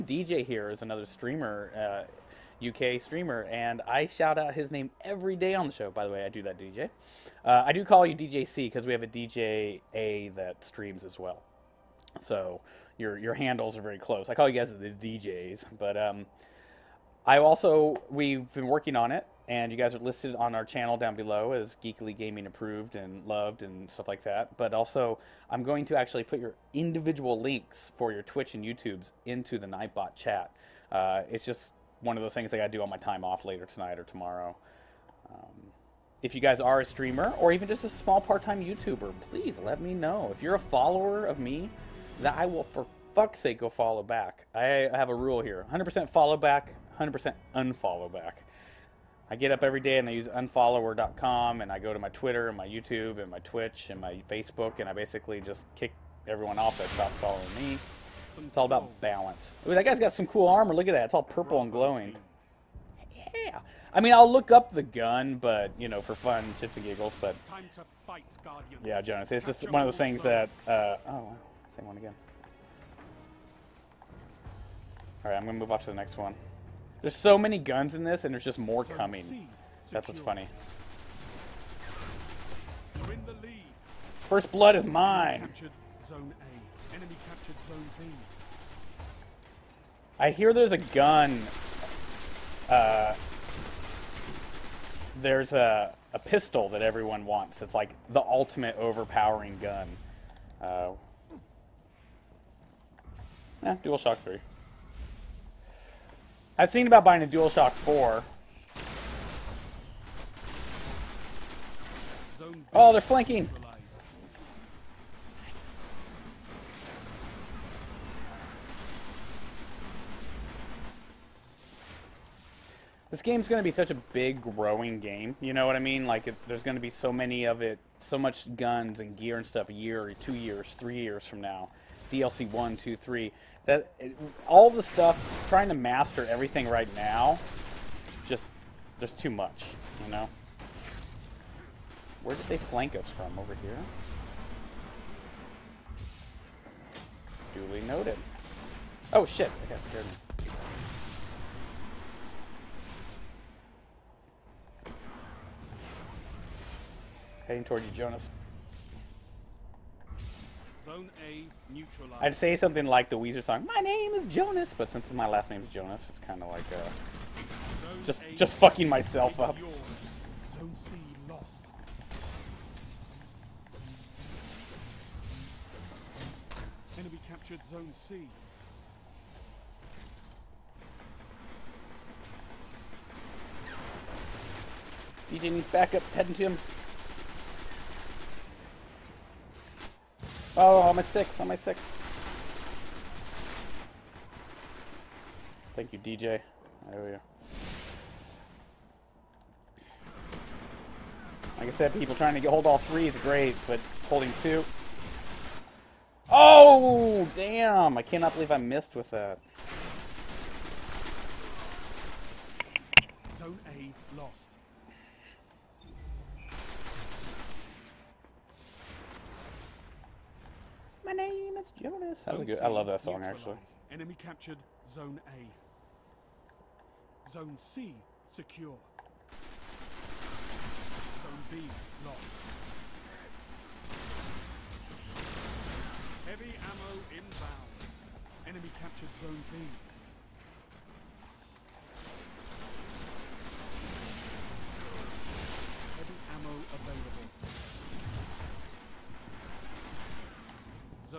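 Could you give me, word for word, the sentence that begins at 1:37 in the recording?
It's like the ultimate overpowering gun.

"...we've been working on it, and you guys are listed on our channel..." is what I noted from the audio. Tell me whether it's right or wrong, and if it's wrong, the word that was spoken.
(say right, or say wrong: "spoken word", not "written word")
right.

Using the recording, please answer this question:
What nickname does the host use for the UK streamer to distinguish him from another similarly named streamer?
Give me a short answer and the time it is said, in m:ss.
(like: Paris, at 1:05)
DJ C, at 0:08.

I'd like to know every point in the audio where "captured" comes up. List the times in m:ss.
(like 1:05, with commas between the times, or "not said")
2:57, 3:44, 3:58.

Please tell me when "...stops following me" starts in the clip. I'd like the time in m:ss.
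0:56.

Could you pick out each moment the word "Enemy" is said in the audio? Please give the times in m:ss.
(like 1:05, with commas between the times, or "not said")
2:56, 3:43, 3:58.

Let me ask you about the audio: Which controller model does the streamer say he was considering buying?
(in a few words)
DualShock 4.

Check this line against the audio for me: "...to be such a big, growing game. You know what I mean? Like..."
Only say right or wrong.
right.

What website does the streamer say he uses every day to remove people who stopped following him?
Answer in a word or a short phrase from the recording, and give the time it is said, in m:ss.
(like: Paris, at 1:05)
unfollower.com, at 0:50.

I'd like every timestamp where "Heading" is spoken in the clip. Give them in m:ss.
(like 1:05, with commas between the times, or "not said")
2:37, 3:06.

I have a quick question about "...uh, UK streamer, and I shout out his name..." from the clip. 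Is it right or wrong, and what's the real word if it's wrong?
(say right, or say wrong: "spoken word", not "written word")
right.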